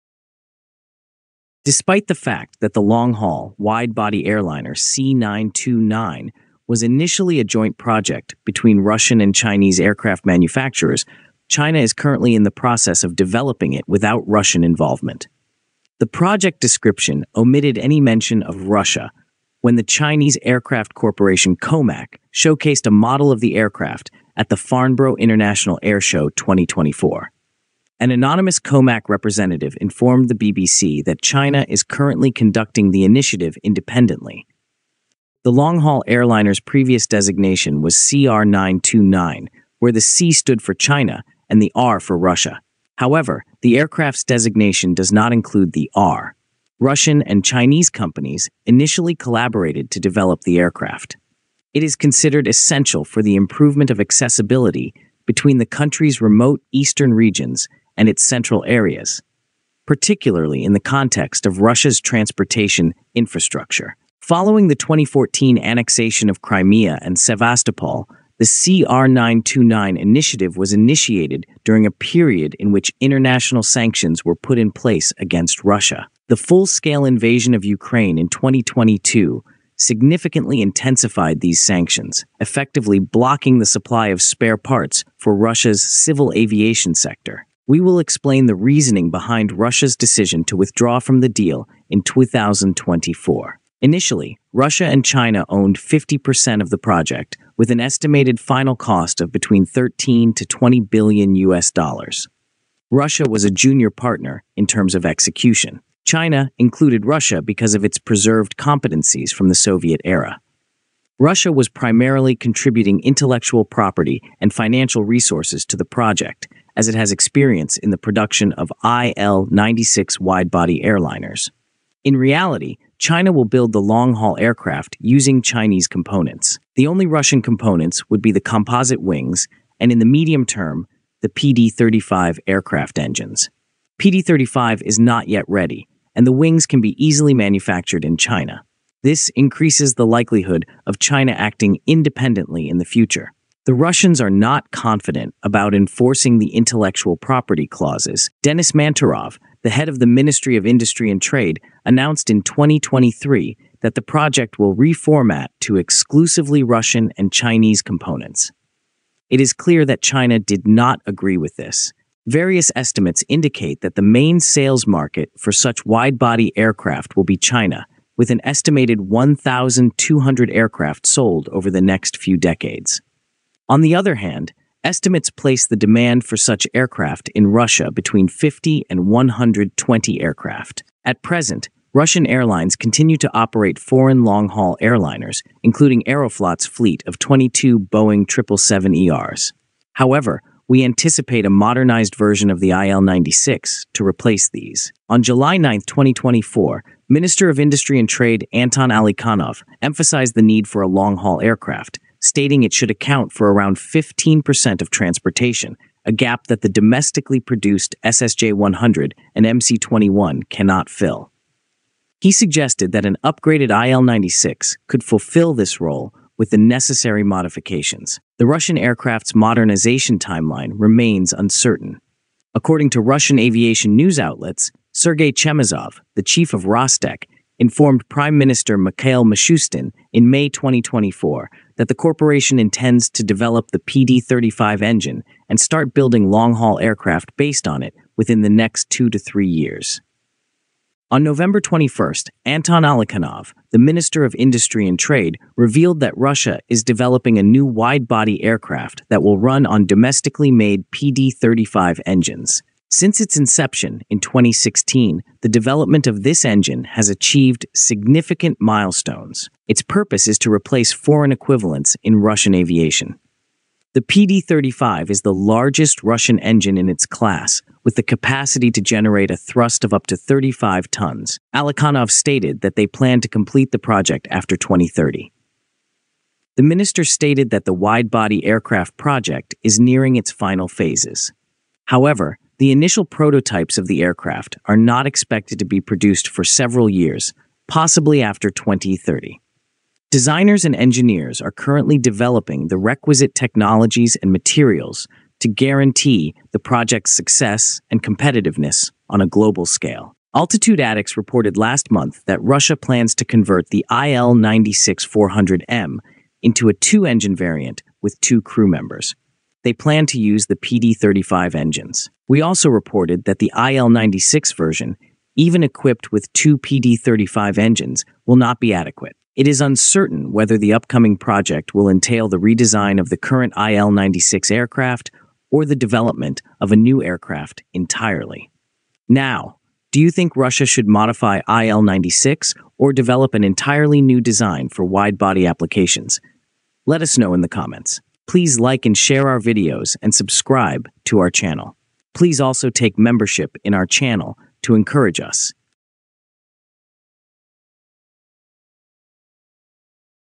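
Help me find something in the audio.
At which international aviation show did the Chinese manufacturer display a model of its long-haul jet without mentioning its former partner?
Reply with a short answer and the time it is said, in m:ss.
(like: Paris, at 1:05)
Farnborough International Airshow 2024, at 0:24.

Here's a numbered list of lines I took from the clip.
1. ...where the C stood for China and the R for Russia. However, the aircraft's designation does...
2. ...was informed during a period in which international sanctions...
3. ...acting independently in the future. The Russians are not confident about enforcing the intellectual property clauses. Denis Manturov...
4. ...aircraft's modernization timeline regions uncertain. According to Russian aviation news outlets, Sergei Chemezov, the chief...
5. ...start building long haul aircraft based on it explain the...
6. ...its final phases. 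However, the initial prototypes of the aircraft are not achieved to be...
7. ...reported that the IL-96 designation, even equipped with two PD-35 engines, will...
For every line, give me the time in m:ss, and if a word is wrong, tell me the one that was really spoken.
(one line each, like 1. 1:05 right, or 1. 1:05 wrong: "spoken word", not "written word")
1. 0:39 right
2. 1:10 wrong: "initiated", not "informed"
3. 2:21 right
4. 3:38 wrong: "remains", not "regions"
5. 3:55 wrong: "within", not "explain"
6. 4:40 wrong: "expected", not "achieved"
7. 5:12 wrong: "version", not "designation".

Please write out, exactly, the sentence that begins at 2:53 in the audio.
On the other hand, estimates place the demand for such aircraft in Russia between 50 and 120 aircraft.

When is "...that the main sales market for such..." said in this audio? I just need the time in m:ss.
2:43.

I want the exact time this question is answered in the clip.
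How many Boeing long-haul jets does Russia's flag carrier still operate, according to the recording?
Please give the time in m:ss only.
3:07.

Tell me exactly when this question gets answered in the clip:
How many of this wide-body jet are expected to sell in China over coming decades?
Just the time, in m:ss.
2:49.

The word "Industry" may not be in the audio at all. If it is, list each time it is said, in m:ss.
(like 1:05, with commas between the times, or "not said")
2:30, 3:17, 4:04.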